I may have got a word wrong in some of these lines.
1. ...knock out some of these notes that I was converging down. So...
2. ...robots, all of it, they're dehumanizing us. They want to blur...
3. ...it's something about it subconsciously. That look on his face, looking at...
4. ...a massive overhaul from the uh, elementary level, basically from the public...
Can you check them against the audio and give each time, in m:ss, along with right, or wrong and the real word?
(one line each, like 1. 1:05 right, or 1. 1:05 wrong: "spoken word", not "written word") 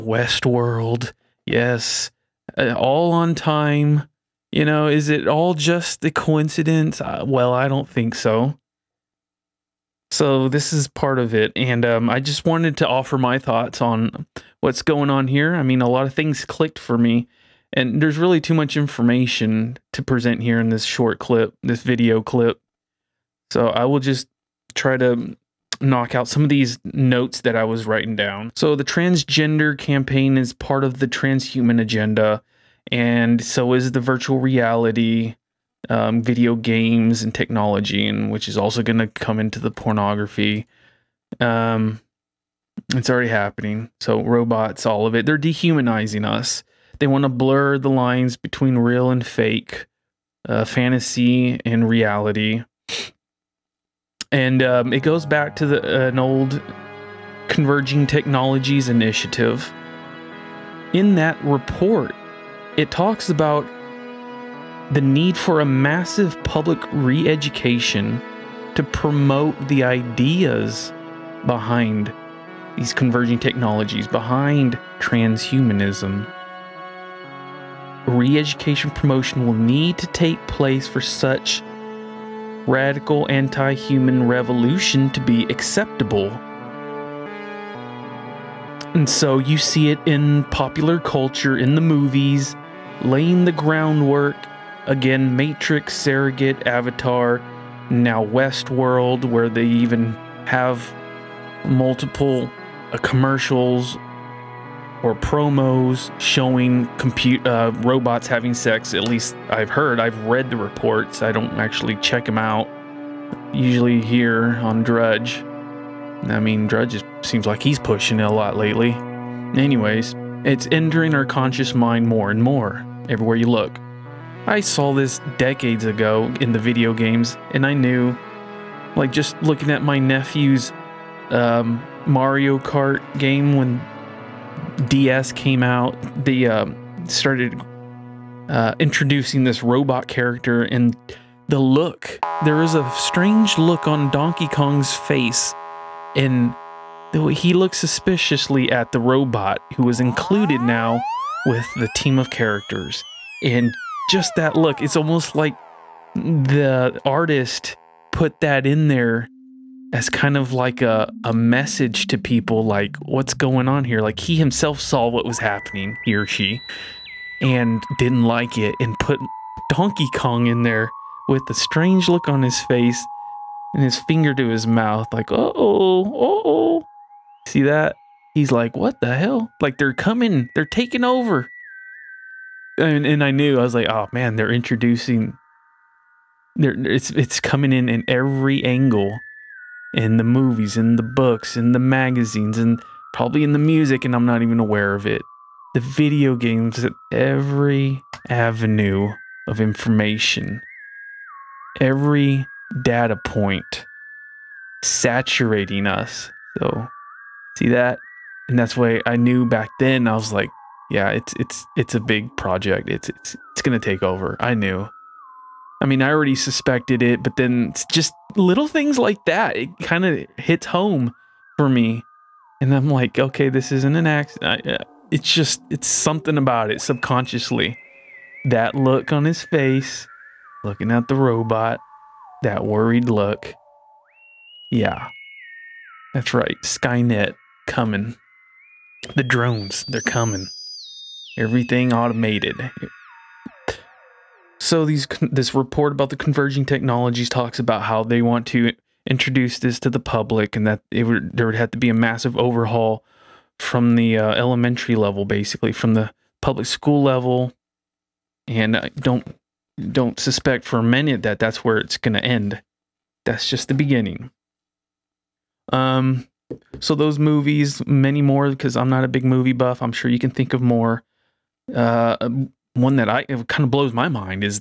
1. 0:25 wrong: "writing", not "converging"
2. 0:44 right
3. 3:45 right
4. 4:11 right.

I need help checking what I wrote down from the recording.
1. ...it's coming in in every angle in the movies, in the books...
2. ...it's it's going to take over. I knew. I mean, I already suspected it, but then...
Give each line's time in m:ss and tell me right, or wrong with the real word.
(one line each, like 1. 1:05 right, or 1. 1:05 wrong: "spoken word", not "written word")
1. 3:07 right
2. 3:33 right.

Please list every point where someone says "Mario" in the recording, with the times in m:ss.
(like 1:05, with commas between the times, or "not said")
2:12.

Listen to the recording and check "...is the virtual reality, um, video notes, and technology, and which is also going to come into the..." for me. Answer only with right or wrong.
wrong.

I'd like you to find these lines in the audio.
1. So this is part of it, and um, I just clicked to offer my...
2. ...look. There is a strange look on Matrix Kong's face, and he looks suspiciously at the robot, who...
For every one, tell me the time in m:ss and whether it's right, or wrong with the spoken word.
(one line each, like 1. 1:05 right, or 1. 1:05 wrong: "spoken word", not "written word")
1. 0:10 wrong: "wanted", not "clicked"
2. 2:21 wrong: "Donkey", not "Matrix".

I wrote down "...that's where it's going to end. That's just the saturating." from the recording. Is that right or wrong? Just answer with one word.
wrong.